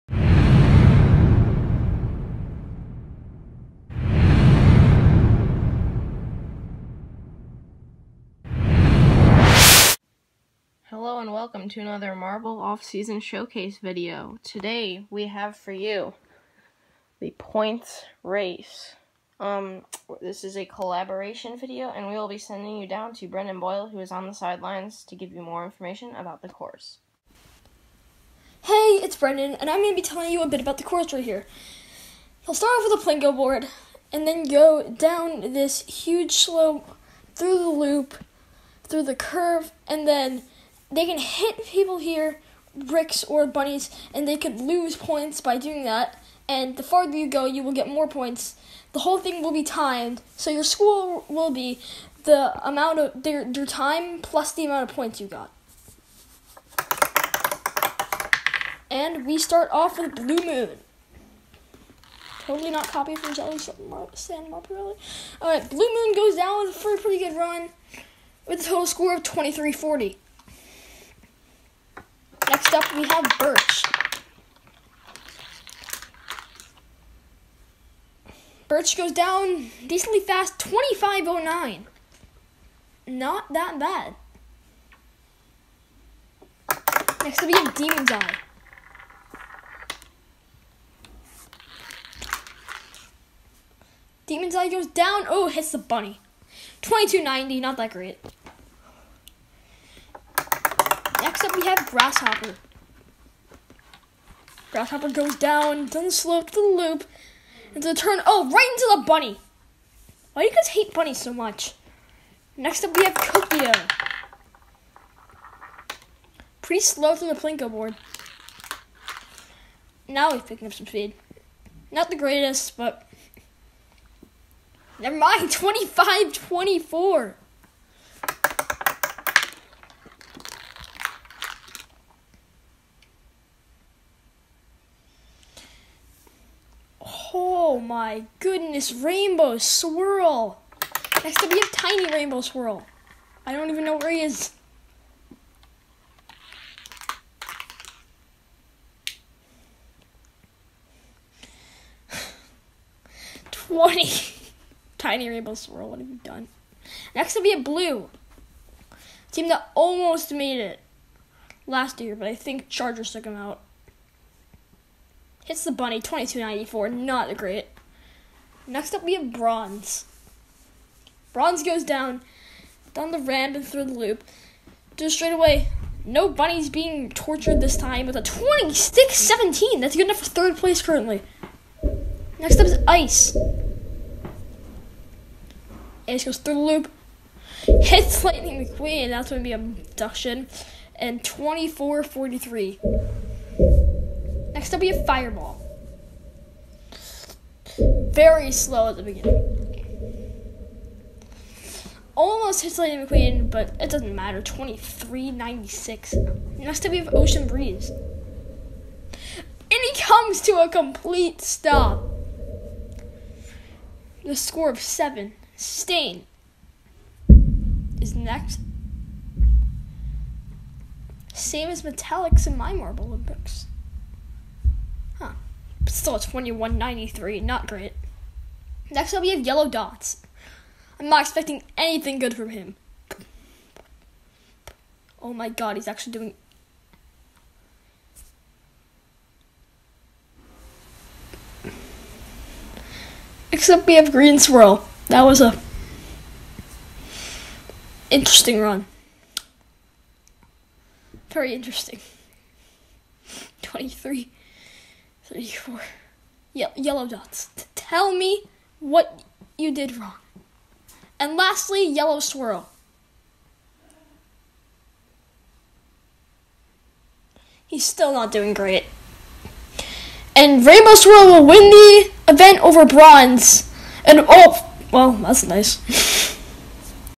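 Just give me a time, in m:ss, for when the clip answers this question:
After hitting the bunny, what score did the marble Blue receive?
2:45.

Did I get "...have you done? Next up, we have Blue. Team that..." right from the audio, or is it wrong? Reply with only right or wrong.
right.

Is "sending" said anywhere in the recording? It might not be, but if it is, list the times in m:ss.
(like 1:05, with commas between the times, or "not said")
0:22.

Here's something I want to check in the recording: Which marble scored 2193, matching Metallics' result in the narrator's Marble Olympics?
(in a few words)
Stain.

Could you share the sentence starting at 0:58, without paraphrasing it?
And we start off with Blue Moon.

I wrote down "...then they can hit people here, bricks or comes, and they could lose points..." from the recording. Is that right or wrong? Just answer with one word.
wrong.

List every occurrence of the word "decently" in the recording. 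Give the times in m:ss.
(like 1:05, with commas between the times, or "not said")
1:19.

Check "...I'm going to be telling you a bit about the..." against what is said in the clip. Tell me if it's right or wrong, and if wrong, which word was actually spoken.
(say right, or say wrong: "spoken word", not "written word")
right.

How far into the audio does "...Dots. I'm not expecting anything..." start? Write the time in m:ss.
3:49.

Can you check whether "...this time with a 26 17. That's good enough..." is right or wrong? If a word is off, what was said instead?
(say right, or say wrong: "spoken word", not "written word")
right.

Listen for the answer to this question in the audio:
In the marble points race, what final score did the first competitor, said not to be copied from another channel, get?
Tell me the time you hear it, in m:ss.
1:09.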